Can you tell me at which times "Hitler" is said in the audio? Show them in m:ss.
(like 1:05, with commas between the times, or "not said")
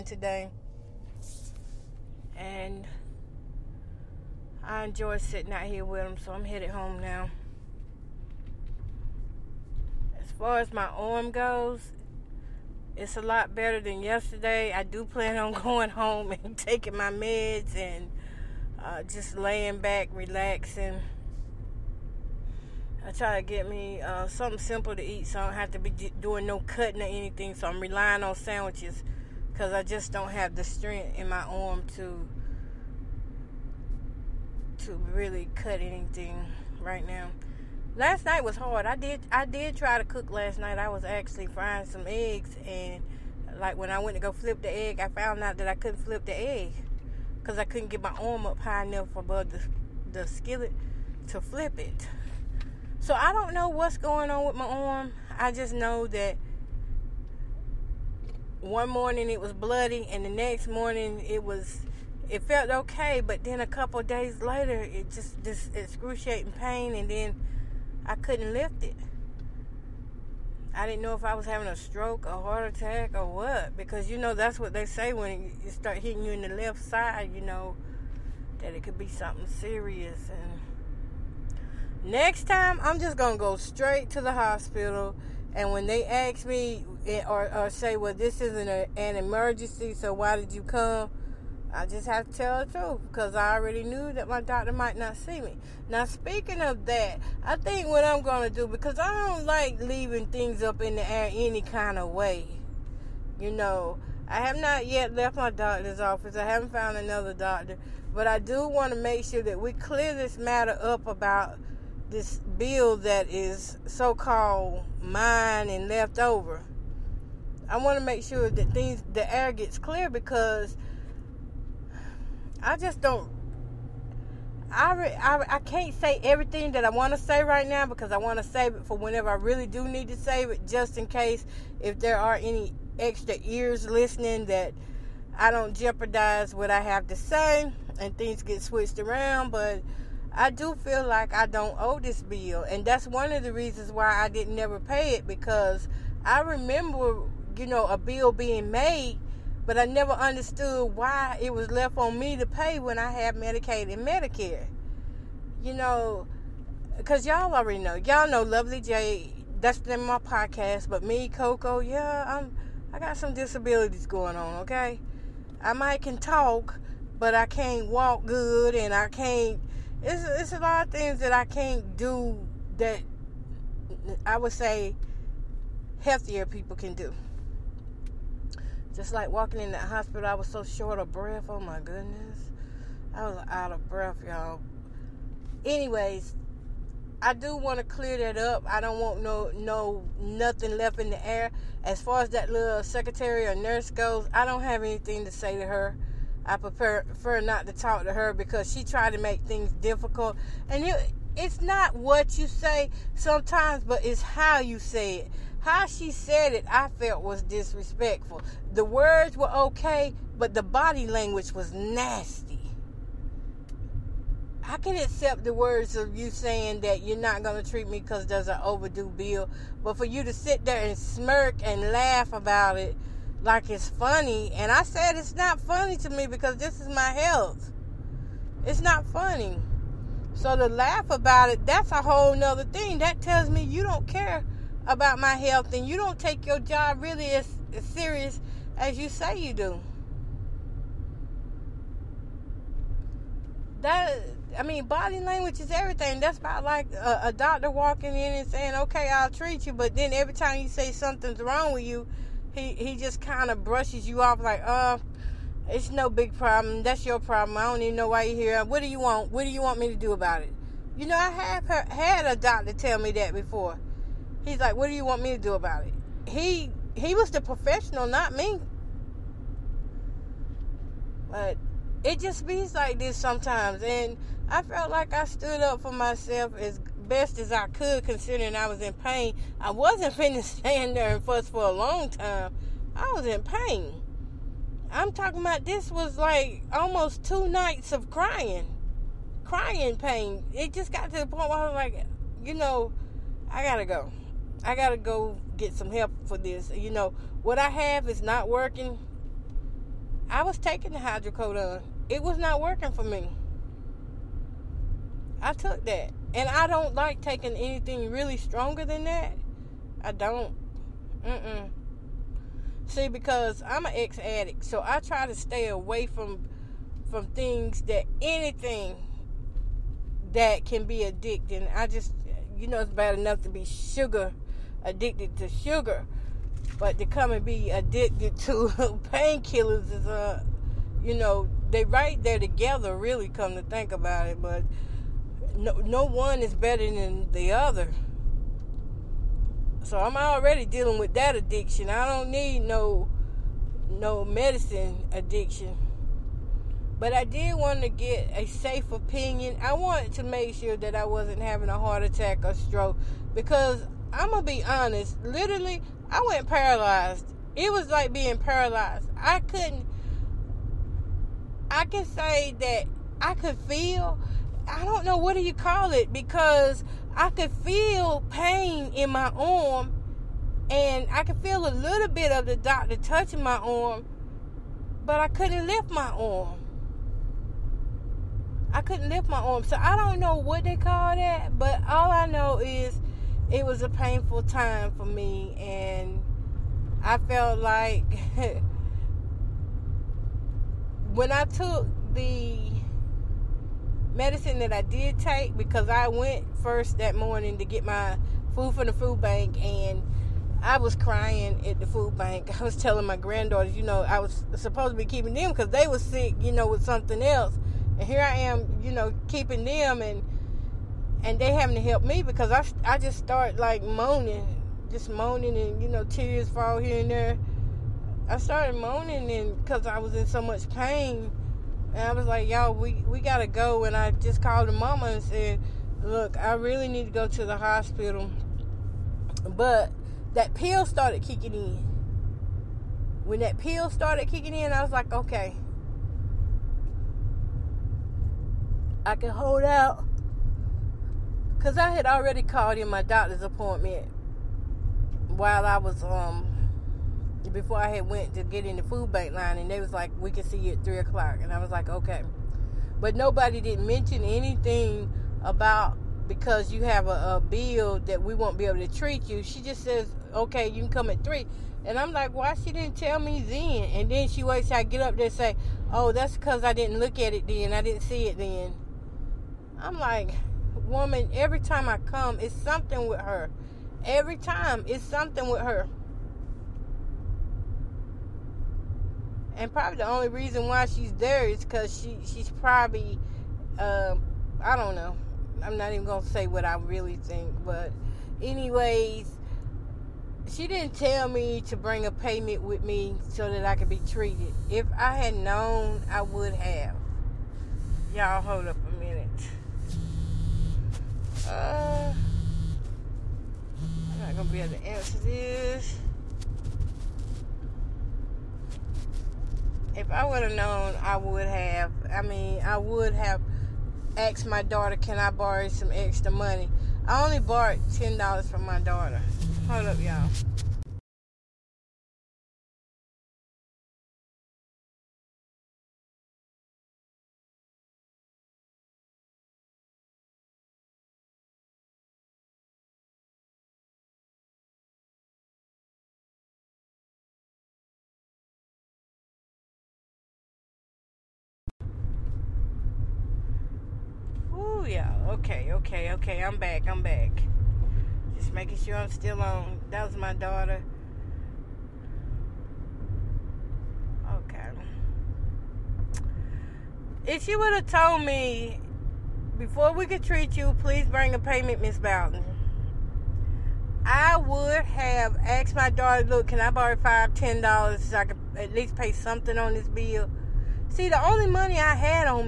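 not said.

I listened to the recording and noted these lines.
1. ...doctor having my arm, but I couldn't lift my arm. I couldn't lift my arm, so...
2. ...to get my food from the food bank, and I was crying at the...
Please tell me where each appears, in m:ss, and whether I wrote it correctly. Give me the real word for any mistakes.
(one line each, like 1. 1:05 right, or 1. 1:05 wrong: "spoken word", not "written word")
1. 6:12 wrong: "touching", not "having"
2. 6:37 right.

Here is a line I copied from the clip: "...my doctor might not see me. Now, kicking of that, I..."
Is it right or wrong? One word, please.
wrong.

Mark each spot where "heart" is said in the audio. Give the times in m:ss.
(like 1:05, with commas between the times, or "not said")
1:12, 5:51.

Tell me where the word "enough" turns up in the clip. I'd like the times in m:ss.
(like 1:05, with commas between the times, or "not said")
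0:48, 5:23.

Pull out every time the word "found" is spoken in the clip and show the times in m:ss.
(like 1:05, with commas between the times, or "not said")
0:45, 1:46.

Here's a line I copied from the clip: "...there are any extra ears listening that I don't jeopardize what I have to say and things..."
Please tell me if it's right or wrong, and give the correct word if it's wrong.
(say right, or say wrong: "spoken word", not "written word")
right.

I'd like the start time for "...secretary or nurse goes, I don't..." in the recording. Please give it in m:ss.
3:12.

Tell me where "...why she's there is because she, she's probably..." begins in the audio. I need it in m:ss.
8:00.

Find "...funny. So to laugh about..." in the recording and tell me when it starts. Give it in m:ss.
3:49.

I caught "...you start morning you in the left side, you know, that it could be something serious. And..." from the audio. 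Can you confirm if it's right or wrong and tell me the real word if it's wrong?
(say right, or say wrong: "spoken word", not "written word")
wrong: "hitting", not "morning".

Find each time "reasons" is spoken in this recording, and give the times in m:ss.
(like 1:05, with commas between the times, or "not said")
2:23, 8:00.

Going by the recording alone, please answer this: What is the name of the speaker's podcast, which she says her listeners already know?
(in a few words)
Lovely J.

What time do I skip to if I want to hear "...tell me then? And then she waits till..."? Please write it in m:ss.
7:42.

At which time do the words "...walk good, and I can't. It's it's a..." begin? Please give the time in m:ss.
2:47.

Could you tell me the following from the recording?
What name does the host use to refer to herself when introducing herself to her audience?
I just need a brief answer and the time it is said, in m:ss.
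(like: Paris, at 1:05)
Coco, at 2:41.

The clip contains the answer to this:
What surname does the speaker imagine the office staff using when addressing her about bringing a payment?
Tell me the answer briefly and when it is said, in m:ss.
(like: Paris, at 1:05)
Bowden, at 9:21.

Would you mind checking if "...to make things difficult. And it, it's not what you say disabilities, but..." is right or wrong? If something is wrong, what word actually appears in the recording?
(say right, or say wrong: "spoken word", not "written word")
wrong: "sometimes", not "disabilities".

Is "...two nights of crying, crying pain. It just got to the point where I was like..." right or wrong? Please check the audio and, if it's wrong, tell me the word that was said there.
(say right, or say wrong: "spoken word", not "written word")
right.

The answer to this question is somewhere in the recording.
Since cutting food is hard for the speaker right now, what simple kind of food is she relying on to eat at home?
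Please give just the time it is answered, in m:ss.
0:28.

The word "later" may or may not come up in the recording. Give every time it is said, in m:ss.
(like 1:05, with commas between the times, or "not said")
1:04.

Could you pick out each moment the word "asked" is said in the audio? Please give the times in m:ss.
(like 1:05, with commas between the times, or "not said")
8:34, 9:25.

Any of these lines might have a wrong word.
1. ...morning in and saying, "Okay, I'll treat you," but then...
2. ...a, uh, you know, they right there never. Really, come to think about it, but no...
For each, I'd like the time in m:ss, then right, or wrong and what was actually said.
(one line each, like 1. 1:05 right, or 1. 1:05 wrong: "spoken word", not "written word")
1. 4:07 wrong: "walking", not "morning"
2. 5:30 wrong: "together", not "never".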